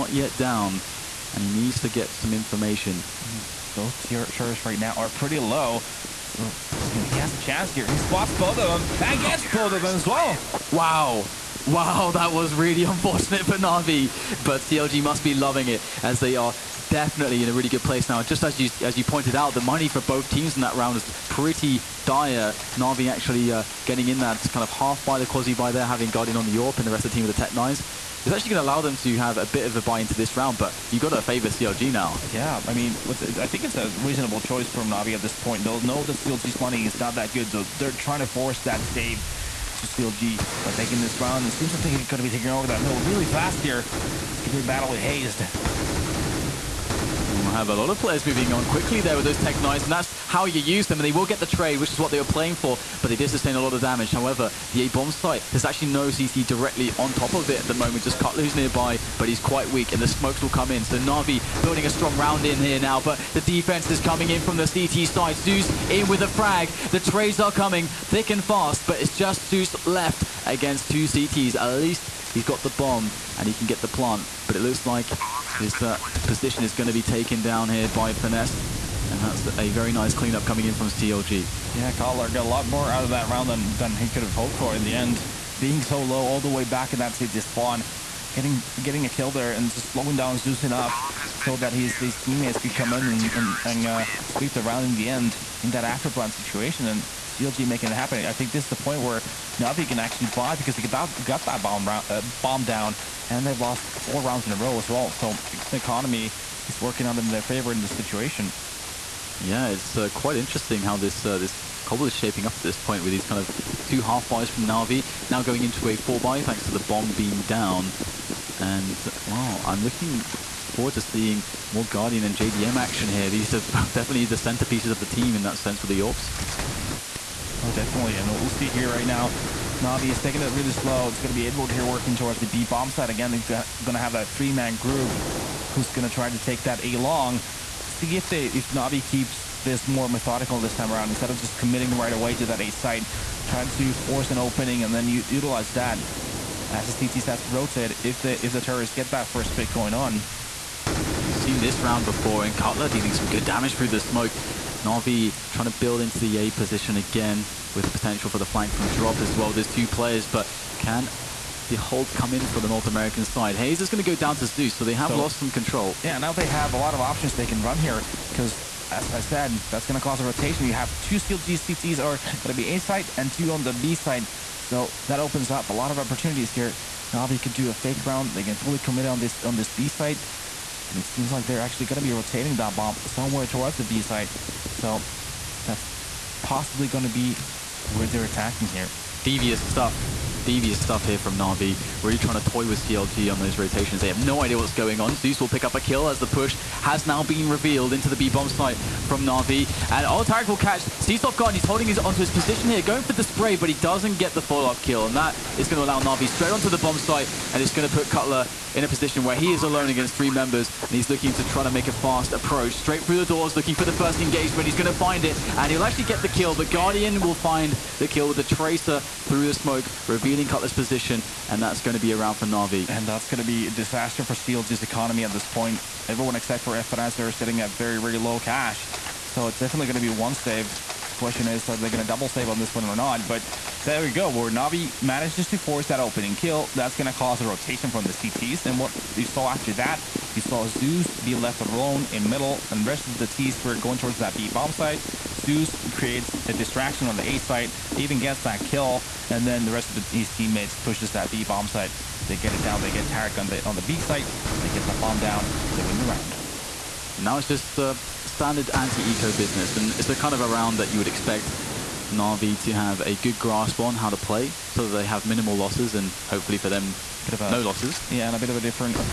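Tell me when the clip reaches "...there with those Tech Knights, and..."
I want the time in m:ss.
0:48.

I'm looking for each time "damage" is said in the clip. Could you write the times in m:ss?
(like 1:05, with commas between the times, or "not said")
0:53, 2:33.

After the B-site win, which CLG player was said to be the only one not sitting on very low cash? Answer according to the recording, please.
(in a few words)
FNS.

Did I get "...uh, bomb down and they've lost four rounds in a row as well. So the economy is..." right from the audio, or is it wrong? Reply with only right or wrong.
right.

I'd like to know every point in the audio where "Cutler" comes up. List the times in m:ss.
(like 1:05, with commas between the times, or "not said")
0:58, 1:21, 2:32, 3:28, 3:40.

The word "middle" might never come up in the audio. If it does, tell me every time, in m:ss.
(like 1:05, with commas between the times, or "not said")
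0:42, 4:02.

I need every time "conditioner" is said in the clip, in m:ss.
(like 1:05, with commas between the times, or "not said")
not said.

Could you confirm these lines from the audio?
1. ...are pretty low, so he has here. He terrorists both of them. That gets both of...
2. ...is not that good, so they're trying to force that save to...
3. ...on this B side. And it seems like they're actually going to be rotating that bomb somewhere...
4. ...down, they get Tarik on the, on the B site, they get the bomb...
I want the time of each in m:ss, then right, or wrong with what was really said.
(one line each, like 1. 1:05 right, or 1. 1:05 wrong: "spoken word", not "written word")
1. 0:04 wrong: "spots", not "terrorists"
2. 0:36 right
3. 2:59 right
4. 4:12 right.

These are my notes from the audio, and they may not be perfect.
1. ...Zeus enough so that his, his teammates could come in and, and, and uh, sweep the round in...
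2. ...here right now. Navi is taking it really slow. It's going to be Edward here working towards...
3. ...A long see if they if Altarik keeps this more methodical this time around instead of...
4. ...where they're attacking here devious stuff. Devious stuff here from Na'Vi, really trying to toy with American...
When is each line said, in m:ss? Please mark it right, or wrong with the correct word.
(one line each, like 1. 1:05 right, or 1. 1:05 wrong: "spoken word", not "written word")
1. 1:30 right
2. 2:08 right
3. 2:16 wrong: "Navi", not "Altarik"
4. 3:07 wrong: "CLG", not "American".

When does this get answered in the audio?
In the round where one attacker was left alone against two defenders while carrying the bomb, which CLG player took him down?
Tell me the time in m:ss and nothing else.
1:18.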